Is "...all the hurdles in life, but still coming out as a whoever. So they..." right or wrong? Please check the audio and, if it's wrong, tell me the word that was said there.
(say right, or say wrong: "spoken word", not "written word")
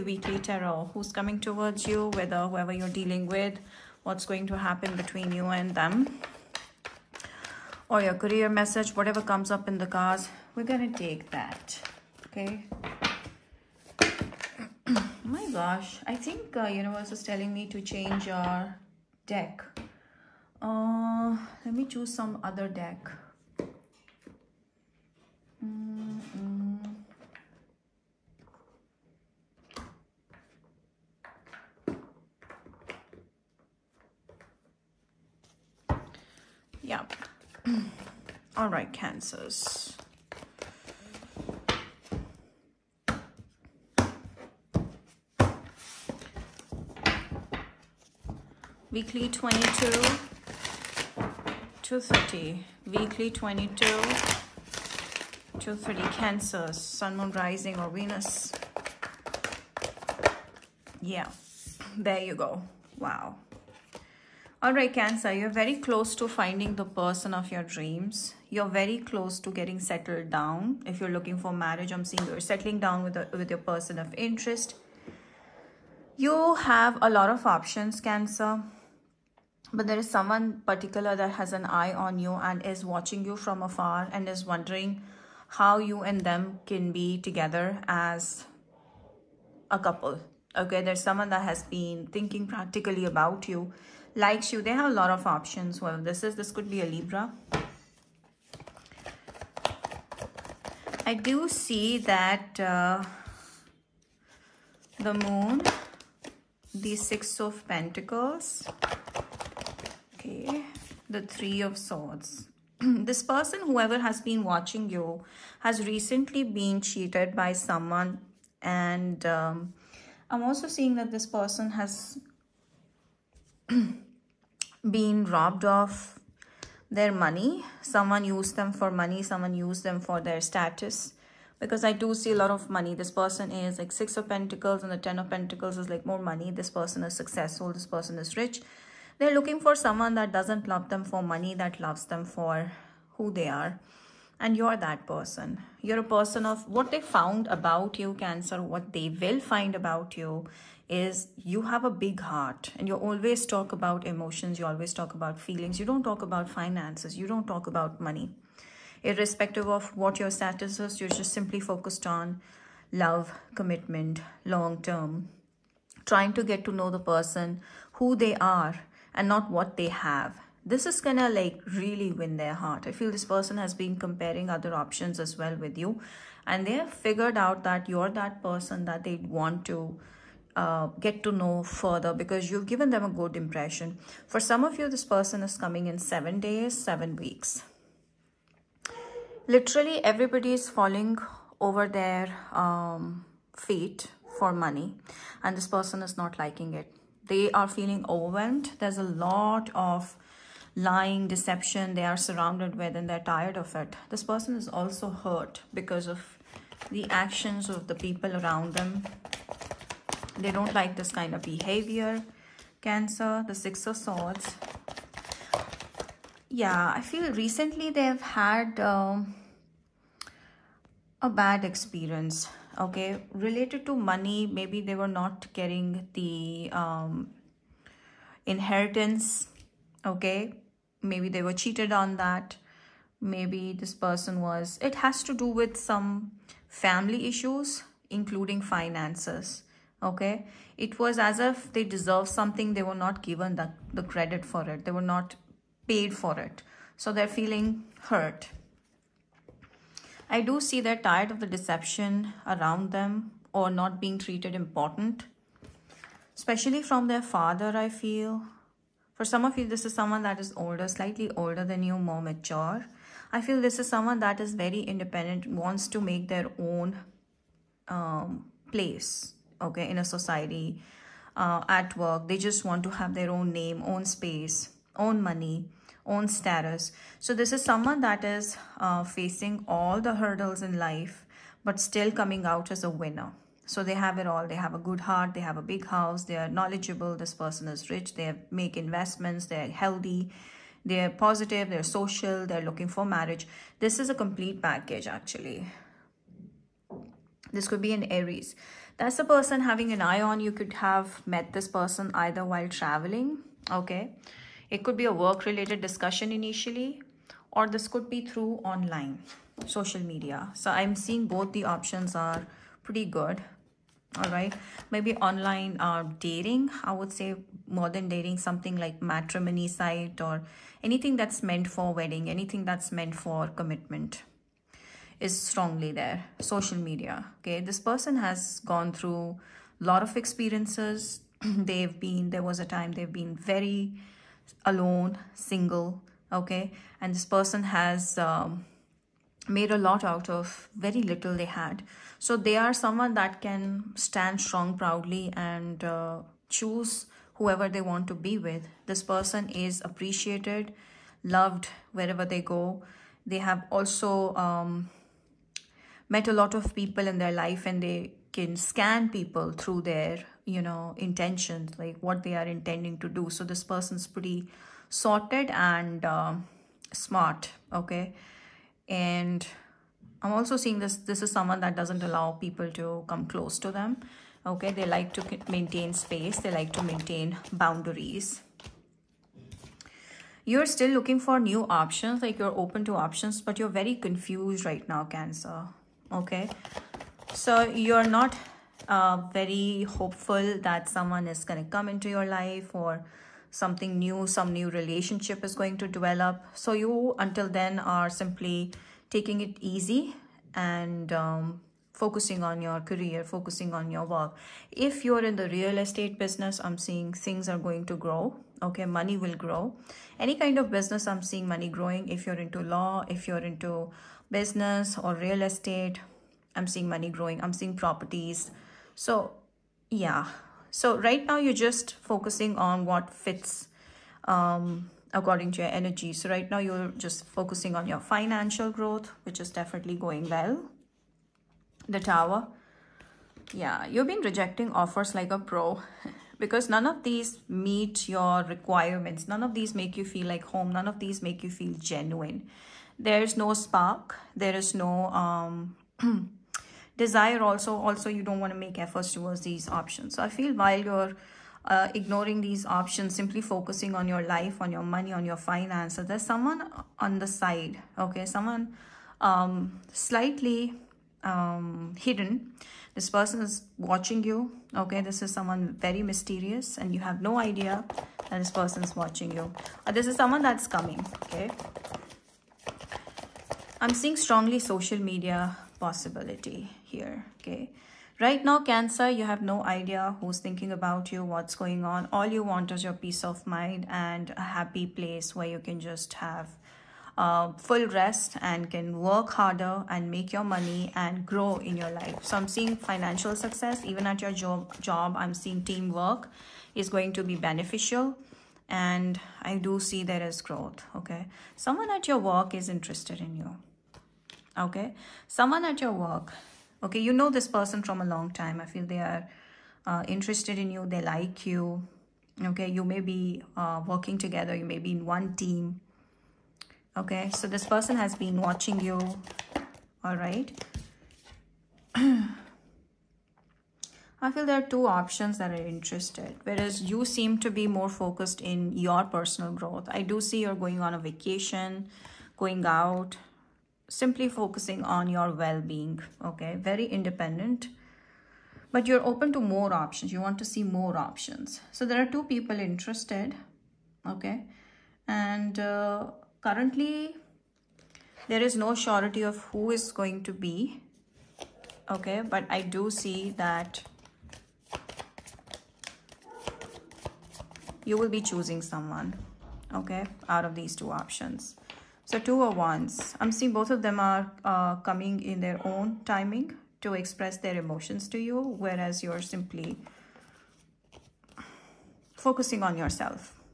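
wrong: "winner", not "whoever".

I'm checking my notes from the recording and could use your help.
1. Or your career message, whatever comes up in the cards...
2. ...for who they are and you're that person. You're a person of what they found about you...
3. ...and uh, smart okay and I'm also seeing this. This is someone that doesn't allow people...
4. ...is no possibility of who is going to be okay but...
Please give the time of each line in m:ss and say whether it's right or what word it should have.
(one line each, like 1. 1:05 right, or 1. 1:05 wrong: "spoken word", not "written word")
1. 0:07 right
2. 2:22 right
3. 6:05 right
4. 9:08 wrong: "surety", not "possibility".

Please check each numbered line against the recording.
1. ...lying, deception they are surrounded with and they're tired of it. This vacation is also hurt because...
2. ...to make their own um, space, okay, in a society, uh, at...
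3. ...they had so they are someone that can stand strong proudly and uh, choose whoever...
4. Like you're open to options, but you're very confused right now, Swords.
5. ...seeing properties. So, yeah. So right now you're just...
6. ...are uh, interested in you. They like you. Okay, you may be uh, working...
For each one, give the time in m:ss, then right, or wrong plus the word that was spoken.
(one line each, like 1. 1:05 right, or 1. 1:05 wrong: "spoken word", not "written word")
1. 3:20 wrong: "person", not "vacation"
2. 4:25 wrong: "place", not "space"
3. 5:41 right
4. 6:22 wrong: "Cancer", not "Swords"
5. 6:57 right
6. 8:28 right.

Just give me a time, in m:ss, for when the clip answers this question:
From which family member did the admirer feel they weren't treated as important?
4:16.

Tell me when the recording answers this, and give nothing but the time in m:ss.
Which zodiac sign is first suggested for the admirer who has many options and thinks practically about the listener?
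1:36.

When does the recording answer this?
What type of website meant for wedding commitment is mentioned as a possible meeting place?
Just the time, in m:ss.
5:19.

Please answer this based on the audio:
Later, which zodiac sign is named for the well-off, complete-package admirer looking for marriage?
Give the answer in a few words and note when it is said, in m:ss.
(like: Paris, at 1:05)
Aries, at 4:57.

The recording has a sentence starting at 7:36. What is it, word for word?
There's someone on the side, okay?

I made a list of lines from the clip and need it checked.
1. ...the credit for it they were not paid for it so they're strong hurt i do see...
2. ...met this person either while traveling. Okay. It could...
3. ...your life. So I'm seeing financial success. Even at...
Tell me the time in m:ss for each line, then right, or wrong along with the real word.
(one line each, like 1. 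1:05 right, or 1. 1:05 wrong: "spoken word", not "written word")
1. 4:03 wrong: "feeling", not "strong"
2. 5:01 right
3. 8:11 right.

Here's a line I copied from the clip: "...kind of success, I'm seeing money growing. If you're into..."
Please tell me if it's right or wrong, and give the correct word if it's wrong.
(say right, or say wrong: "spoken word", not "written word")
wrong: "business", not "success".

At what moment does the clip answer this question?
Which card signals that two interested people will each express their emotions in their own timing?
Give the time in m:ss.
9:22.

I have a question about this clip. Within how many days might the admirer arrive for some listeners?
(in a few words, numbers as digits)
7.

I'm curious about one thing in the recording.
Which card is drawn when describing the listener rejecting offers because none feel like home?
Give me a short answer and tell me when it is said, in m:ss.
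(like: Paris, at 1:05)
The Tower, at 7:11.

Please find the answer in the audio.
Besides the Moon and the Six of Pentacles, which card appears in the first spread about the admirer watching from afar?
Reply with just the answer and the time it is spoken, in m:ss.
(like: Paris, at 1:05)
Three of Swords, at 1:51.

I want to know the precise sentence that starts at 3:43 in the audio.
Related to money, maybe they were not getting the um, inheritance, okay?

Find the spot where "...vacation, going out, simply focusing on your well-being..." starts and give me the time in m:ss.
8:50.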